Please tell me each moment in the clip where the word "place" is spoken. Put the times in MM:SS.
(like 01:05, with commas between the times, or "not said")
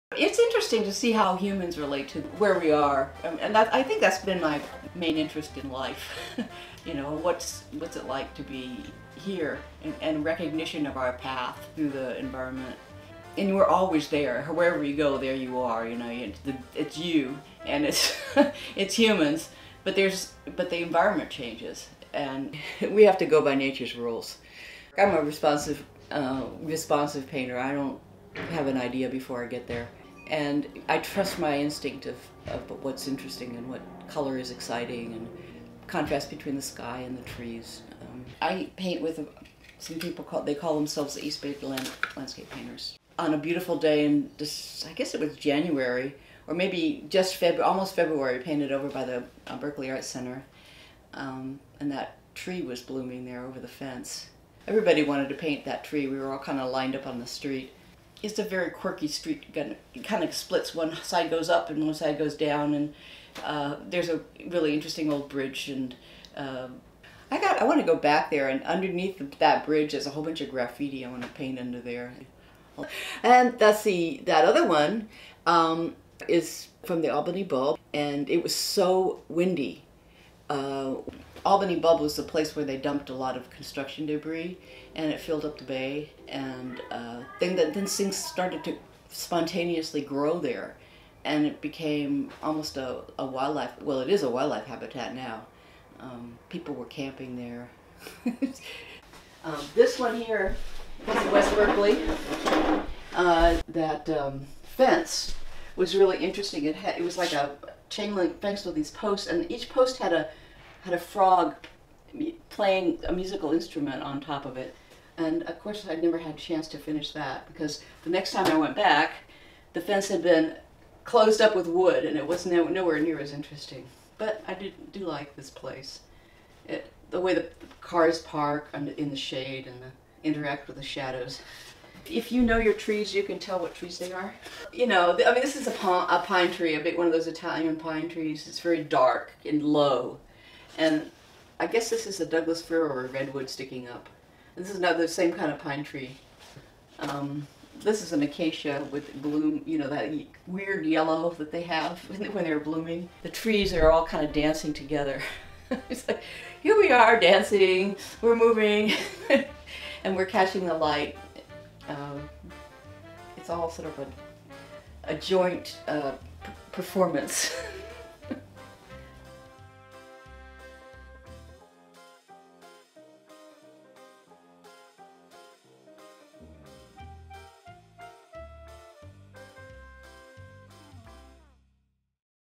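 01:22, 02:05.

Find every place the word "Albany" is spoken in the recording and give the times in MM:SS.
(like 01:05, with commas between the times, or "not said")
01:17, 01:21.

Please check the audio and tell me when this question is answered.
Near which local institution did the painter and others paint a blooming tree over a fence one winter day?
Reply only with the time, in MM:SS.
00:49.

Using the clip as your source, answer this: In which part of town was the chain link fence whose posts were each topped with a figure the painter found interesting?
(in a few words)
West Berkeley.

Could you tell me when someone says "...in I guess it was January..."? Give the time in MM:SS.
00:44.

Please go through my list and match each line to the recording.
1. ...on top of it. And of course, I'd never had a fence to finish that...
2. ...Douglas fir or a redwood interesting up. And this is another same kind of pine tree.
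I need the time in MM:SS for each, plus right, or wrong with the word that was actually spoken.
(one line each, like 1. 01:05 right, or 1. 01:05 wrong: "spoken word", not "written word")
1. 01:54 wrong: "chance", not "fence"
2. 02:22 wrong: "sticking", not "interesting".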